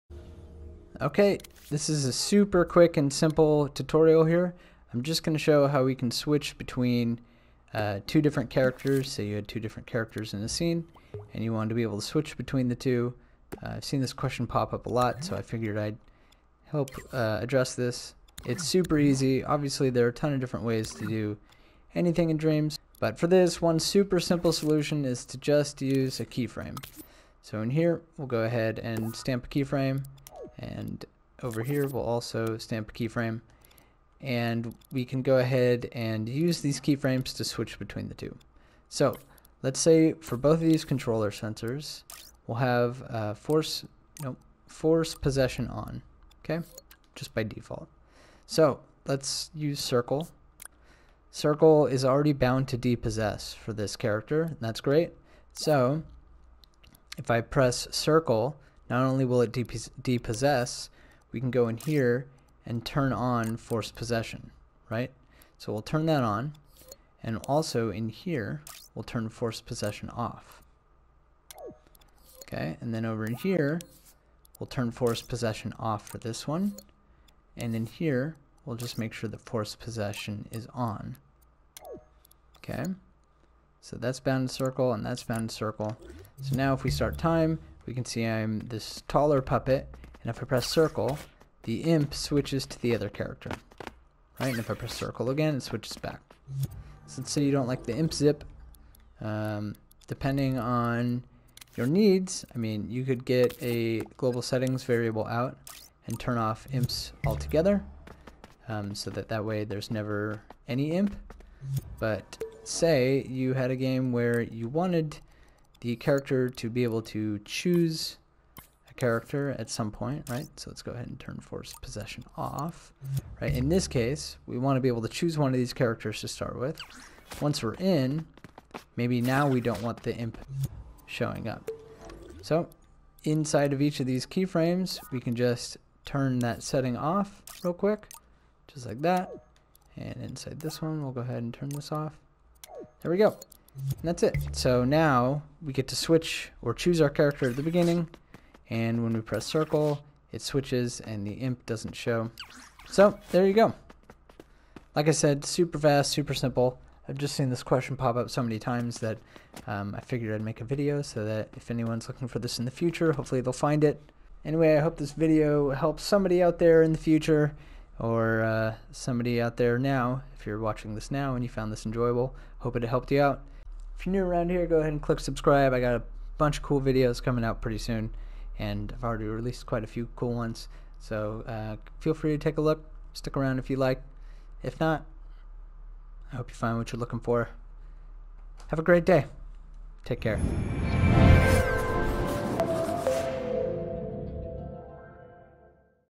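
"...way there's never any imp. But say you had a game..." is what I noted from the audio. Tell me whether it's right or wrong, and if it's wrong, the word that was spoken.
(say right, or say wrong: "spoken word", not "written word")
right.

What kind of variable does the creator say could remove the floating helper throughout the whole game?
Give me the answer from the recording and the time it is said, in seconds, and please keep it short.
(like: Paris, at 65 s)
Global settings, at 104 s.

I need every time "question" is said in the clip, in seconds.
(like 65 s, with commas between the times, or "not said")
14 s, 157 s.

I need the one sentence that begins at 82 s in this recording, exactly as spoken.
Okay, so that's bounded circle, and that's bounded circle.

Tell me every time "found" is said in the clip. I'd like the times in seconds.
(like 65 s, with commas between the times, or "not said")
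171 s.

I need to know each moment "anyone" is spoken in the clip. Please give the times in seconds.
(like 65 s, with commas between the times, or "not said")
161 s.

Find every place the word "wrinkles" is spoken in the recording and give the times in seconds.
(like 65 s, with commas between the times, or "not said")
not said.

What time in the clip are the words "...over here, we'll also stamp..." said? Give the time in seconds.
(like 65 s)
31 s.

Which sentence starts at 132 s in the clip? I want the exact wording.
So inside of each of these keyframes, we can just turn that setting off real quick, just like that.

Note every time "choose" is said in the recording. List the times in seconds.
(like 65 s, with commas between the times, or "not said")
117 s, 125 s, 146 s.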